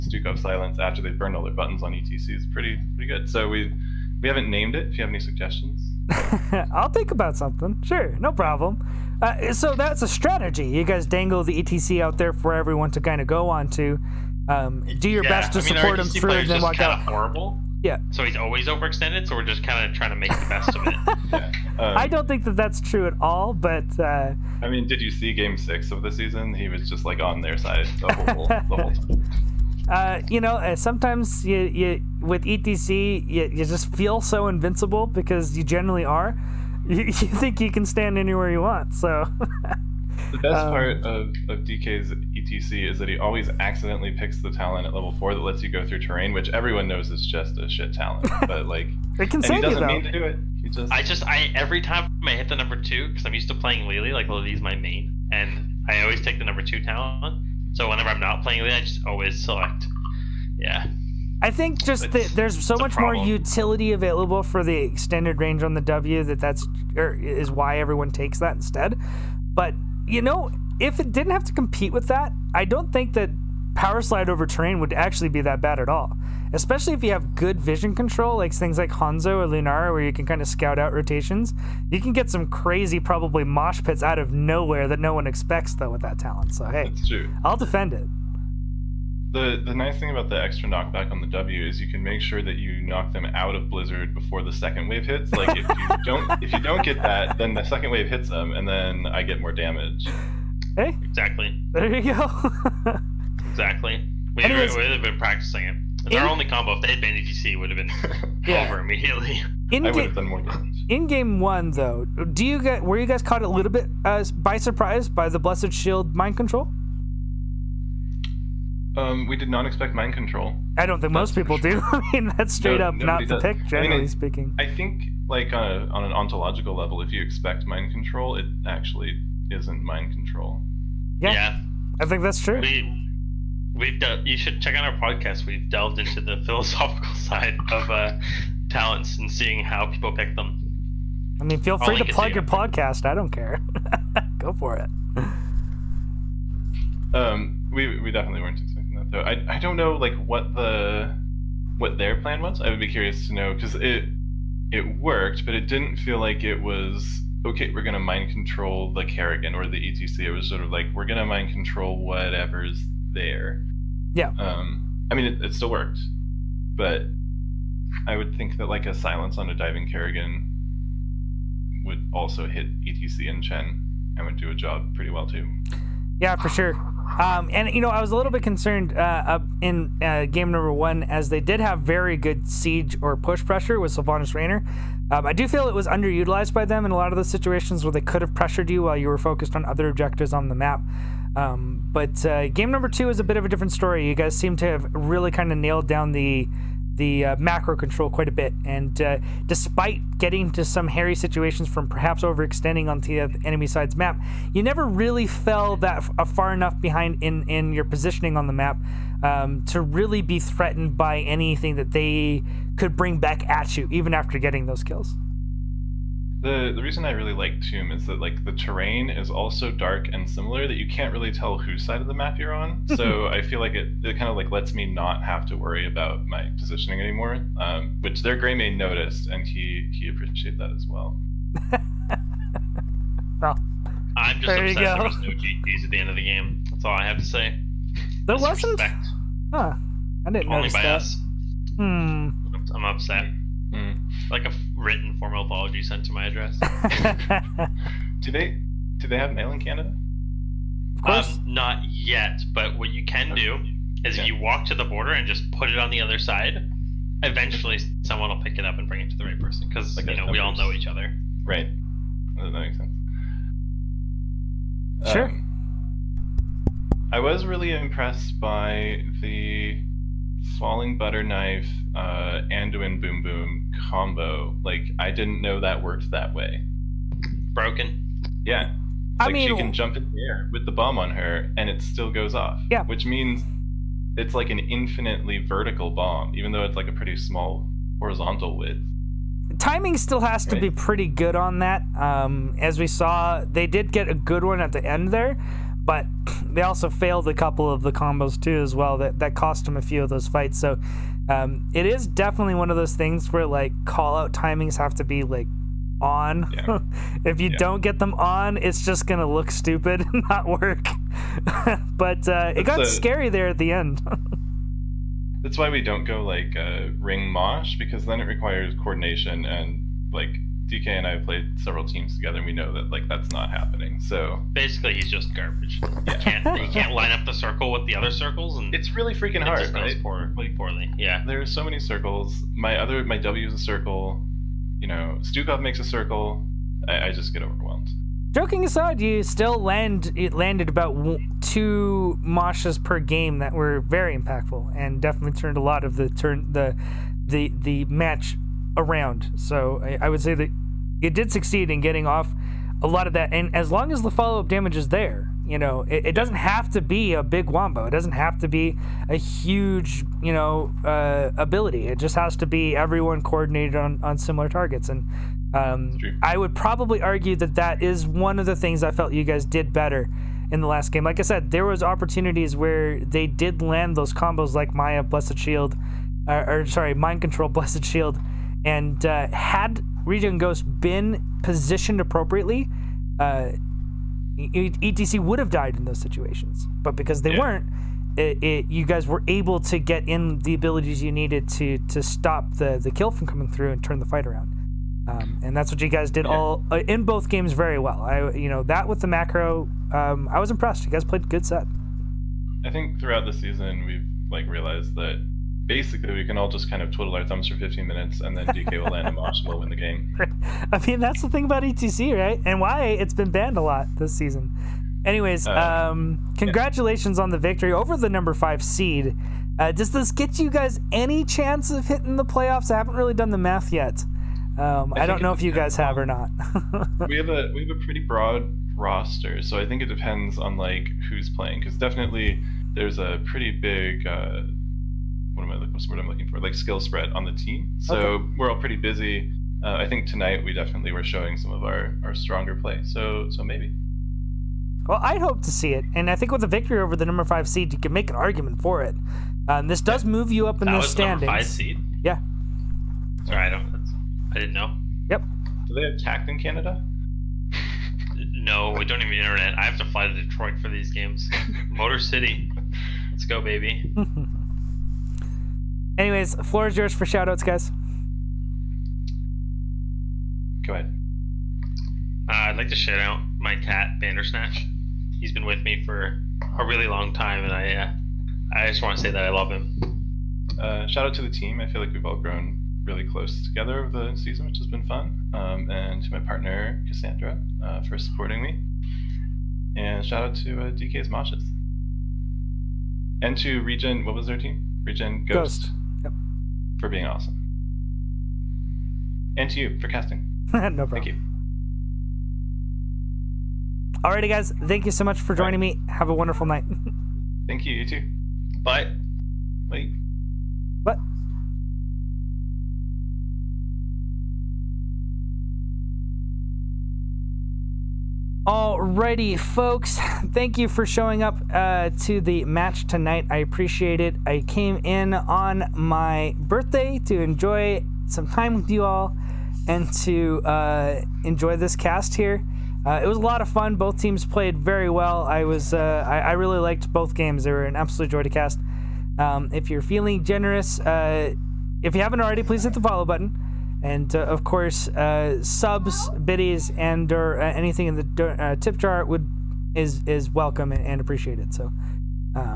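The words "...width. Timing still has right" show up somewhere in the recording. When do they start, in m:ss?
4:48.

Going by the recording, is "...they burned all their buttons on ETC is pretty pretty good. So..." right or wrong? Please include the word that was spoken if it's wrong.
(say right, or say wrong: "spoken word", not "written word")
right.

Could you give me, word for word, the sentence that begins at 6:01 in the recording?
It just has to be everyone coordinated on, on similar targets.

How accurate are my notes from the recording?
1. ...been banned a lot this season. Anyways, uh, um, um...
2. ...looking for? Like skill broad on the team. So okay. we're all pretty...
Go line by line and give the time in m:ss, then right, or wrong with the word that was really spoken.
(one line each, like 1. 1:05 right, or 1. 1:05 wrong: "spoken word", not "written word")
1. 6:53 right
2. 7:16 wrong: "spread", not "broad".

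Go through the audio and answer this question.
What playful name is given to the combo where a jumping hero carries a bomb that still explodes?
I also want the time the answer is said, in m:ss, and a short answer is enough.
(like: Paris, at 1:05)
Falling Butter Knife, at 4:30.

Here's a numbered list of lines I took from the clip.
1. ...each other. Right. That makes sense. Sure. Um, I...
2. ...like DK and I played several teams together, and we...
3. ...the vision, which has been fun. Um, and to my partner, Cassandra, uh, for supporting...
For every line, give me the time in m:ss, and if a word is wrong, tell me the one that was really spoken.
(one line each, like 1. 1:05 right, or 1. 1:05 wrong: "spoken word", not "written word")
1. 4:20 right
2. 5:20 right
3. 8:04 wrong: "season", not "vision".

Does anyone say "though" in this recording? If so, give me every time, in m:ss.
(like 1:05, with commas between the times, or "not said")
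0:49, 1:25, 1:51, 2:29, 4:46.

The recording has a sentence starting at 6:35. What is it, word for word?
Um, and that's what you guys did yeah.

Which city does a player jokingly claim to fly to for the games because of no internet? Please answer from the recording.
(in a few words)
Detroit.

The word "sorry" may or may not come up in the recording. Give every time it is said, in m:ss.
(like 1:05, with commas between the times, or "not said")
6:16, 7:33.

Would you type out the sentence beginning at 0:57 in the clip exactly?
So whenever I'm not playing Lily, I just always select.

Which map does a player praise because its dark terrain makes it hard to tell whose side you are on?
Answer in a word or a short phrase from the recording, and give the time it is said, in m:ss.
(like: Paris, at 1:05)
Tomb, at 3:37.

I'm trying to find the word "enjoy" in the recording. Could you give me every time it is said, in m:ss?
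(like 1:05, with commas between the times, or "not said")
8:47, 8:51.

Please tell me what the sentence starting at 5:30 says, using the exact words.
Yeah, there are so many circles.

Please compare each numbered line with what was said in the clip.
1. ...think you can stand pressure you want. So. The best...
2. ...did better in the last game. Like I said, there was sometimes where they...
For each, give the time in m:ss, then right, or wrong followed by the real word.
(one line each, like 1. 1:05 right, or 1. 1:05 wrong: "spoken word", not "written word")
1. 0:37 wrong: "anywhere", not "pressure"
2. 6:09 wrong: "opportunities", not "sometimes".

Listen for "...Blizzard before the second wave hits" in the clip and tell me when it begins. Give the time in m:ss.
1:33.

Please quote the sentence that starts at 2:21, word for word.
I mean, feel free to plug your podcast.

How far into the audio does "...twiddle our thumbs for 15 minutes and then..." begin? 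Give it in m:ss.
6:46.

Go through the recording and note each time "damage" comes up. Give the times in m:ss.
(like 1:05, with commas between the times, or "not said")
1:39, 1:50, 5:54.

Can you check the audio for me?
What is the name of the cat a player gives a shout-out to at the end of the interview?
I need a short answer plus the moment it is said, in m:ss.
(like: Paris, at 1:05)
Bandersnatch, at 7:53.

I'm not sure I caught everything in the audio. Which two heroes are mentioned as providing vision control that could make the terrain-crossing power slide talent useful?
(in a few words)
Hanzo or Lunara.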